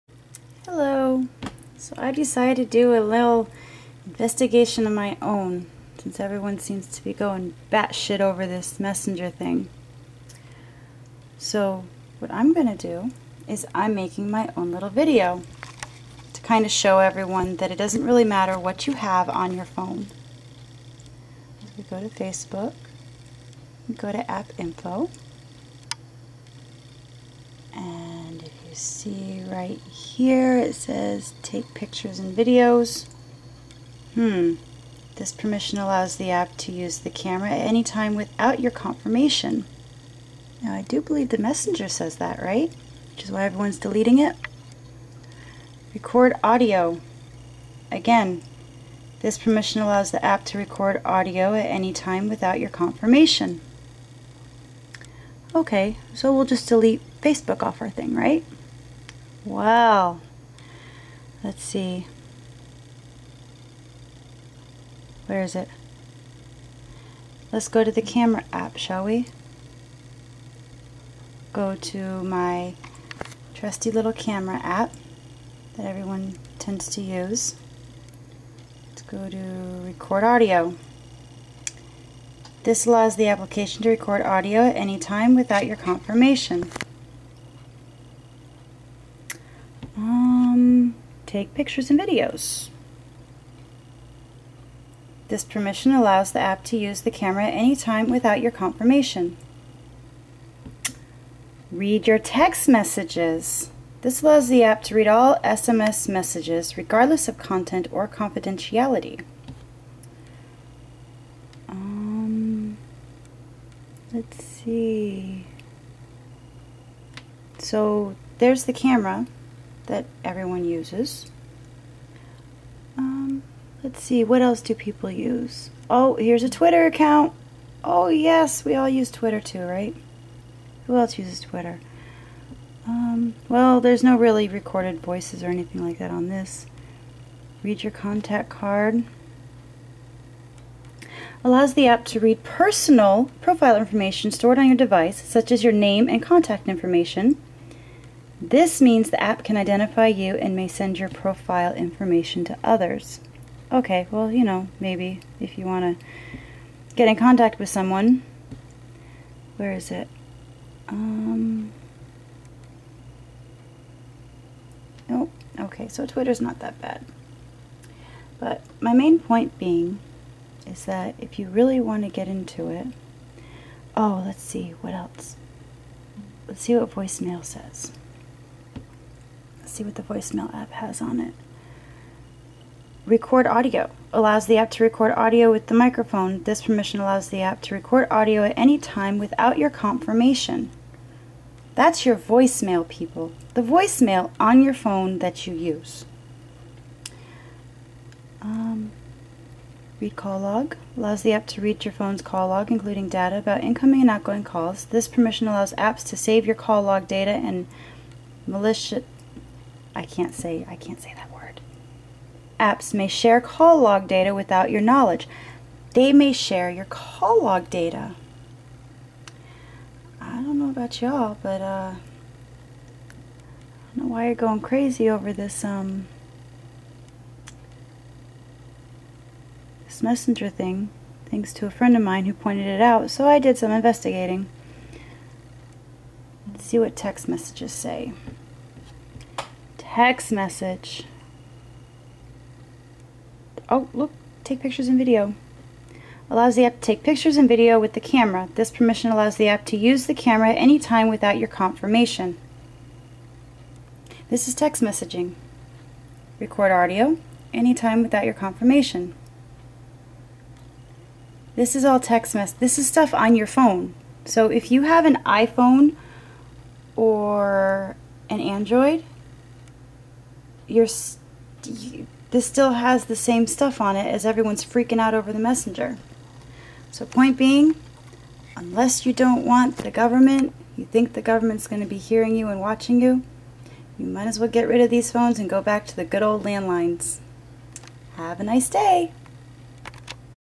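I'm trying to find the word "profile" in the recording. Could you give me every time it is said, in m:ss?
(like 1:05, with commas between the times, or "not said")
2:23, 2:31.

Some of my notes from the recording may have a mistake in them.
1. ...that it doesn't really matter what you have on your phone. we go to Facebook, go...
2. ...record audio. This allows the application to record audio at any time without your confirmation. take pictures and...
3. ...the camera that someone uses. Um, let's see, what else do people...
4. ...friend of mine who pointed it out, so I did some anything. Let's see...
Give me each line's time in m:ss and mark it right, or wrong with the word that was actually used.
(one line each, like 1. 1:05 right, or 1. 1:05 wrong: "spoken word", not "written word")
1. 0:17 right
2. 1:19 right
3. 1:58 wrong: "everyone", not "someone"
4. 3:51 wrong: "investigating", not "anything".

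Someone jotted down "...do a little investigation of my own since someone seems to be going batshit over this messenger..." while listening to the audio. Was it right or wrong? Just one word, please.
wrong.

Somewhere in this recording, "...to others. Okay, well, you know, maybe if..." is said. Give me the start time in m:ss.
2:32.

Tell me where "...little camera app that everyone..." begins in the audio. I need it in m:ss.
1:13.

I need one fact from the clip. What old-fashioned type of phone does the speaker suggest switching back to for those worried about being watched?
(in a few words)
Landlines.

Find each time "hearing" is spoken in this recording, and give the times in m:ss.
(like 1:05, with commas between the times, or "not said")
4:41.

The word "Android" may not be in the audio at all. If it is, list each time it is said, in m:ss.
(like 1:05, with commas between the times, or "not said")
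4:28.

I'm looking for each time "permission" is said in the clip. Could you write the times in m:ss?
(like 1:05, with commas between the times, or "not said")
0:35, 0:49, 1:35, 3:06, 3:25, 4:08.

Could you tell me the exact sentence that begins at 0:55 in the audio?
Okay, so we'll just delete Facebook off our thing, right?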